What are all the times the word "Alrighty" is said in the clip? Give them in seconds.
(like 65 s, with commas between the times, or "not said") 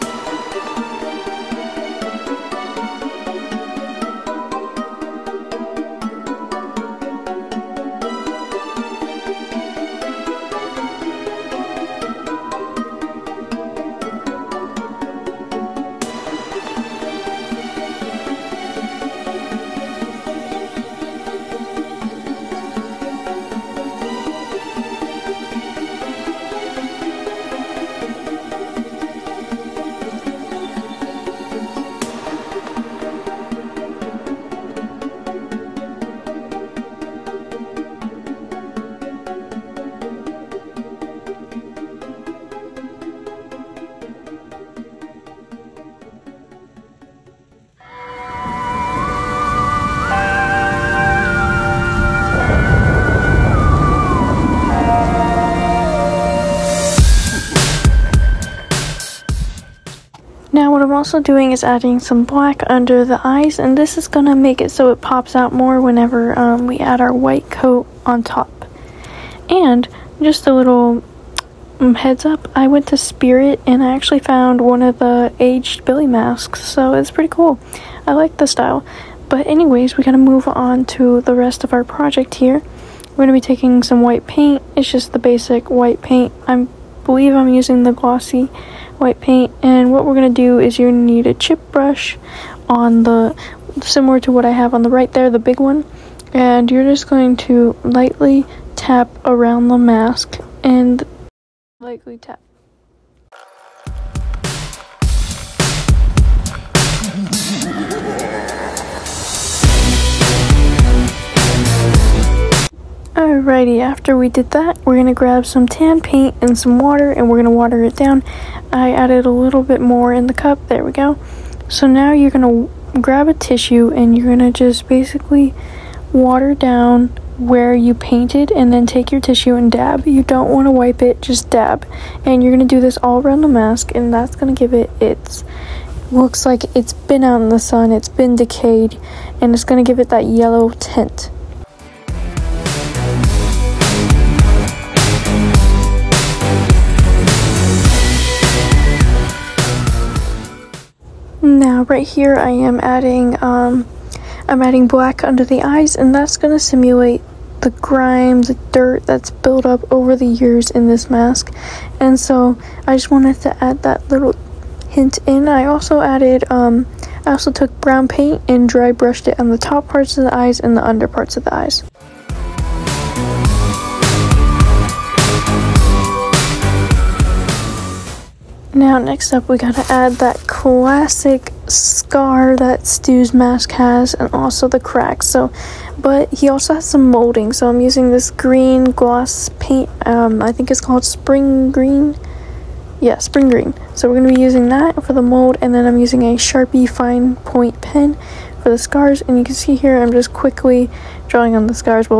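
113 s.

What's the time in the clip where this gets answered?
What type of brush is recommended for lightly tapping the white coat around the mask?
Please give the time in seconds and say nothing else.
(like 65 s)
91 s.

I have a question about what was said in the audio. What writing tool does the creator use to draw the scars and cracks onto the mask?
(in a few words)
Sharpie fine point pen.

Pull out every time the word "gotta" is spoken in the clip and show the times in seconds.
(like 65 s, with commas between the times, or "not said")
80 s, 179 s.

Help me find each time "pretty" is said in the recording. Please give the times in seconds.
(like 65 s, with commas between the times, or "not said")
77 s.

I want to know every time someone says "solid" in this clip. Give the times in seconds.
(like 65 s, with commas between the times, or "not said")
not said.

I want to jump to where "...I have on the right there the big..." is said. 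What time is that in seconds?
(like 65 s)
94 s.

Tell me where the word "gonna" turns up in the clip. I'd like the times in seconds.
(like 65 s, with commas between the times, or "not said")
83 s, 194 s.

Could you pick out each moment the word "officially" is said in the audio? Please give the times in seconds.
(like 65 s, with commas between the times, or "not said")
not said.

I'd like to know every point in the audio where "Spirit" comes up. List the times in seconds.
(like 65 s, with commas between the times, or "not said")
72 s.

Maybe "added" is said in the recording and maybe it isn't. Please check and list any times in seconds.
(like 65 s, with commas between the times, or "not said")
118 s, 166 s.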